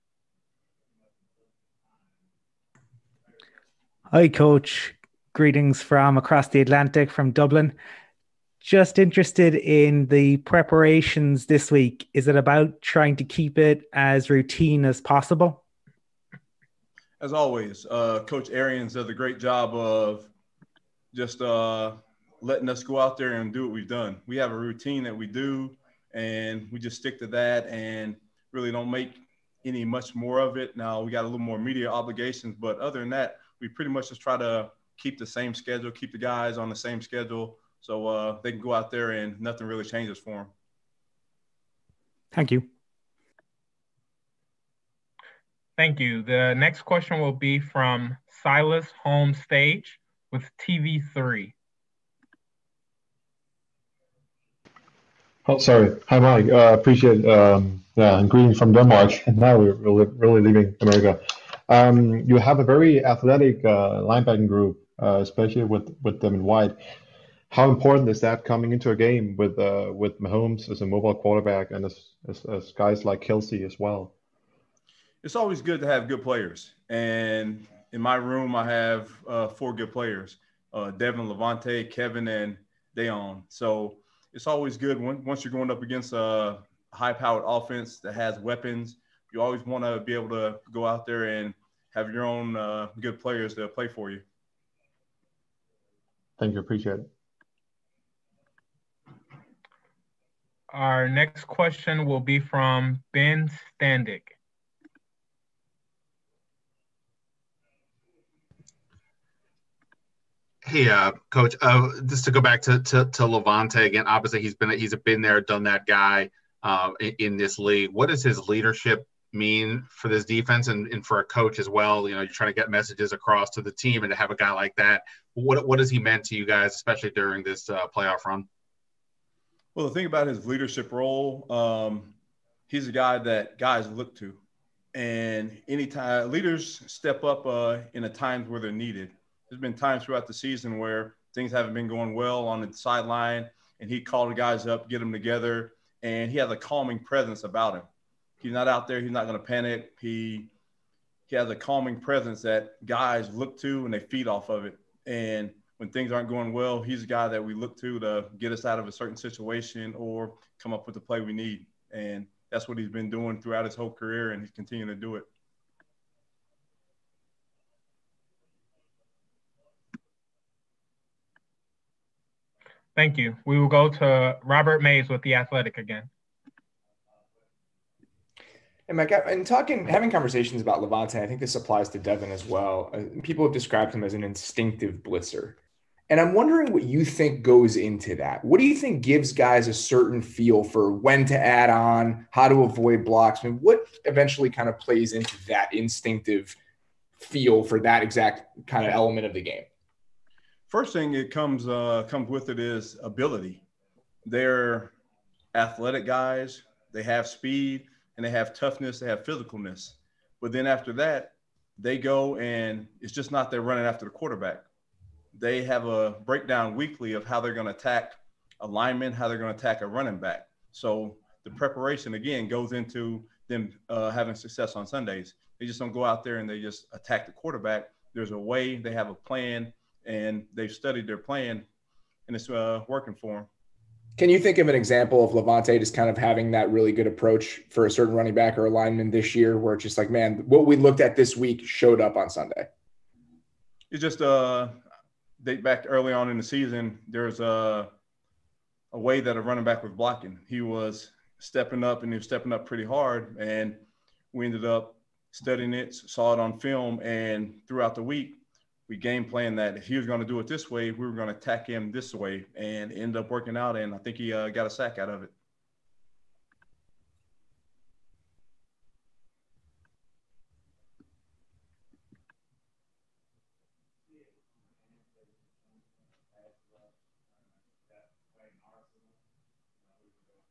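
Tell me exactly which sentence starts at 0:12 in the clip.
Is it about trying to keep it as routine as possible?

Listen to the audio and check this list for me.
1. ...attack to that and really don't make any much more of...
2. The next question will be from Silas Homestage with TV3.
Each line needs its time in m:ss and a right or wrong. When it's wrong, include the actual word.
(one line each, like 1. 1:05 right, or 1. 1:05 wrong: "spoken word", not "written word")
1. 0:26 wrong: "stick", not "attack"
2. 0:46 right.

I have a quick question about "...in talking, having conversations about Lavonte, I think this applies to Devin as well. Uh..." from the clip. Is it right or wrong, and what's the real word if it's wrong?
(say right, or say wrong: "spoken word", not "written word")
right.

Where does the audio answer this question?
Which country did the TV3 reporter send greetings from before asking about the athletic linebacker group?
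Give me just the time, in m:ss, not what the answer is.
0:58.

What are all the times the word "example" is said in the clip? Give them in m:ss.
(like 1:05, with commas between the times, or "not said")
3:54.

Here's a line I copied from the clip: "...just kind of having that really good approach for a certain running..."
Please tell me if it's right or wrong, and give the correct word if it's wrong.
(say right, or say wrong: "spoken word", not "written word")
right.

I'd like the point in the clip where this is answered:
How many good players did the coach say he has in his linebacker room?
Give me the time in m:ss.
1:19.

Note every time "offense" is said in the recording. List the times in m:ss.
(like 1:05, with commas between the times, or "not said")
1:27.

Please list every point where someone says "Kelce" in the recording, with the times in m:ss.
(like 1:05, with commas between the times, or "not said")
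1:13.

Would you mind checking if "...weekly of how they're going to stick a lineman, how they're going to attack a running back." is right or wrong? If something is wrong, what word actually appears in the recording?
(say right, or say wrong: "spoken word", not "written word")
wrong: "attack", not "stick".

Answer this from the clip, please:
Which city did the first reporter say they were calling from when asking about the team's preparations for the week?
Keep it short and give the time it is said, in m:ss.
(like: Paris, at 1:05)
Dublin, at 0:07.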